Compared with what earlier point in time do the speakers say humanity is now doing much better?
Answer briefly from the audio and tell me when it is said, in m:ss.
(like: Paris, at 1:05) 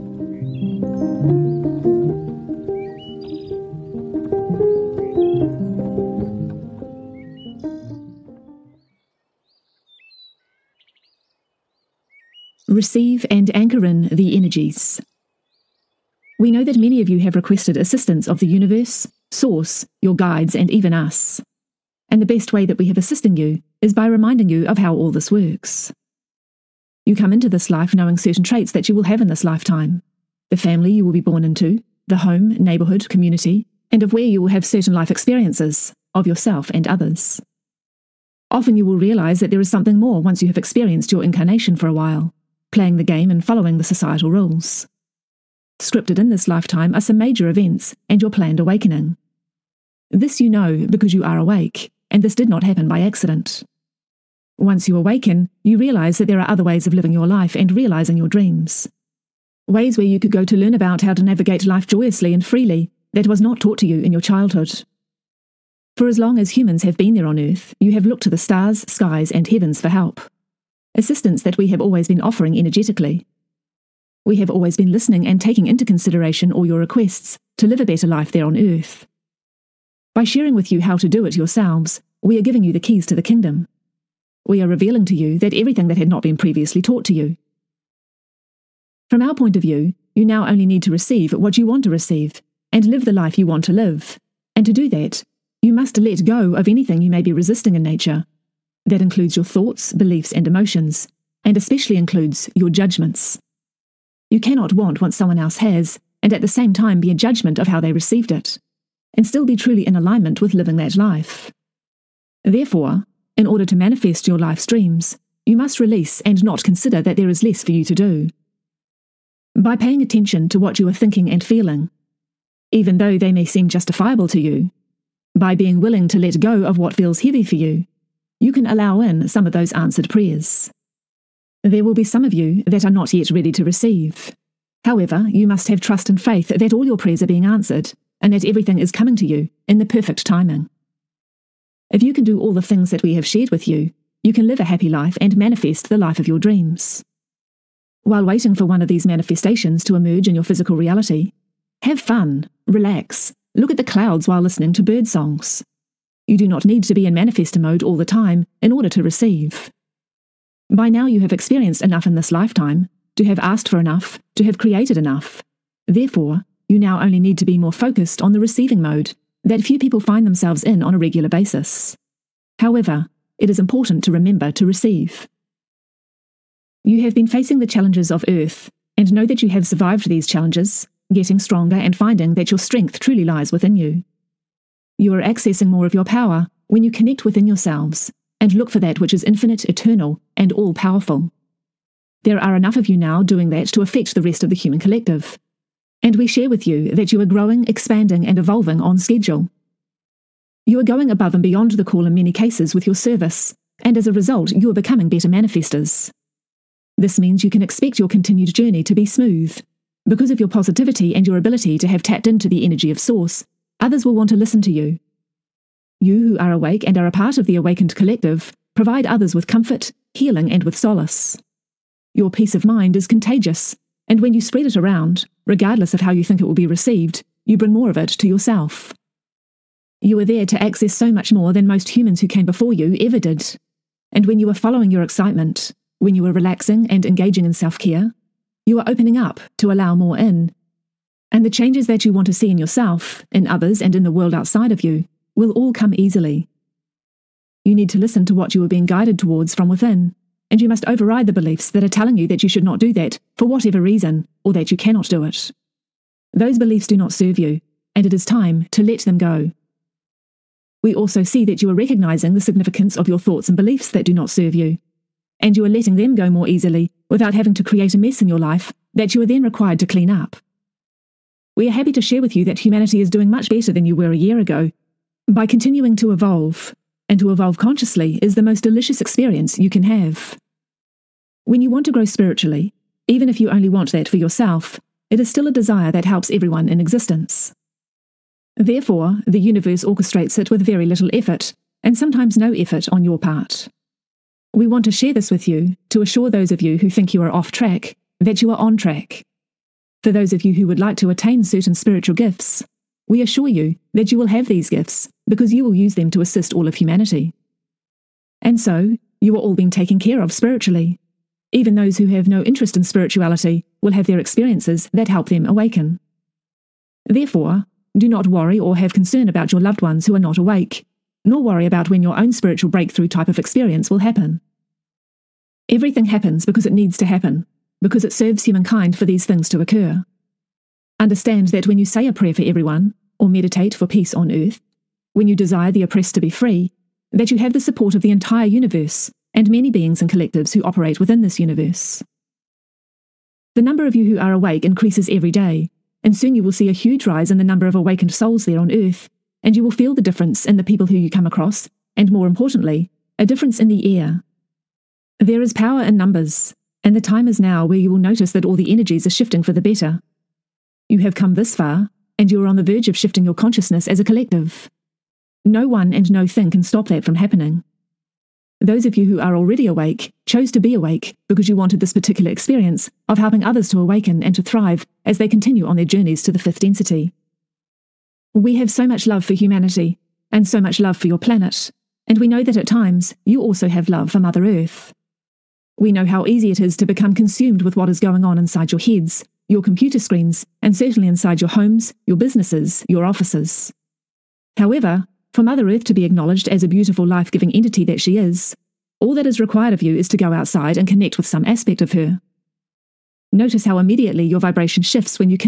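A year ago, at 4:34.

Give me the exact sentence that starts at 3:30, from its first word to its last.
Because of your positivity and your ability to have tapped into the energy of Source, others will want to listen to you.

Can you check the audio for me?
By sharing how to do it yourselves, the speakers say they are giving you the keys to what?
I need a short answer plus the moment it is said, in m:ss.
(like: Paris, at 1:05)
The kingdom, at 1:23.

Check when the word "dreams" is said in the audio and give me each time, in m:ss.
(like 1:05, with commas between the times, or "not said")
0:58, 1:54, 2:26.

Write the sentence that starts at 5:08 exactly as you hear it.
And so, you are all being taken care of spiritually.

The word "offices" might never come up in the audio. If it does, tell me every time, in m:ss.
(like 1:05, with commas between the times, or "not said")
6:33.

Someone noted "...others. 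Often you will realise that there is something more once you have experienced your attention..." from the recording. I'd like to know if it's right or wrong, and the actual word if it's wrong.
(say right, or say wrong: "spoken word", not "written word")
wrong: "incarnation", not "attention".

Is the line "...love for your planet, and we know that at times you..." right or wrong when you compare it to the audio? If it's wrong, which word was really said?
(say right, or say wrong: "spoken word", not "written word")
right.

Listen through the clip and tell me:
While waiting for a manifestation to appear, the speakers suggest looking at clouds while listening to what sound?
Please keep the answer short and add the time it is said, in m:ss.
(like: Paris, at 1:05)
Bird songs, at 2:34.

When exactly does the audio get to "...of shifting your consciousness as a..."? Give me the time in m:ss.
6:02.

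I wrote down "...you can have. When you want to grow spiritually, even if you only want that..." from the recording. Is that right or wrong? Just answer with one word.
right.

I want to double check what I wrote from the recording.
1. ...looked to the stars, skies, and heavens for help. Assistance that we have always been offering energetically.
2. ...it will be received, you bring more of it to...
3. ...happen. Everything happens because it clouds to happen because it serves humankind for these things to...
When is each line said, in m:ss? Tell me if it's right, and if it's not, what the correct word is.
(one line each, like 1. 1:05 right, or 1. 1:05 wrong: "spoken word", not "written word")
1. 1:08 right
2. 3:46 right
3. 5:23 wrong: "needs", not "clouds".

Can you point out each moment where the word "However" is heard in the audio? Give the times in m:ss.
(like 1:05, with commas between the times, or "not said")
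2:14, 2:52, 6:34.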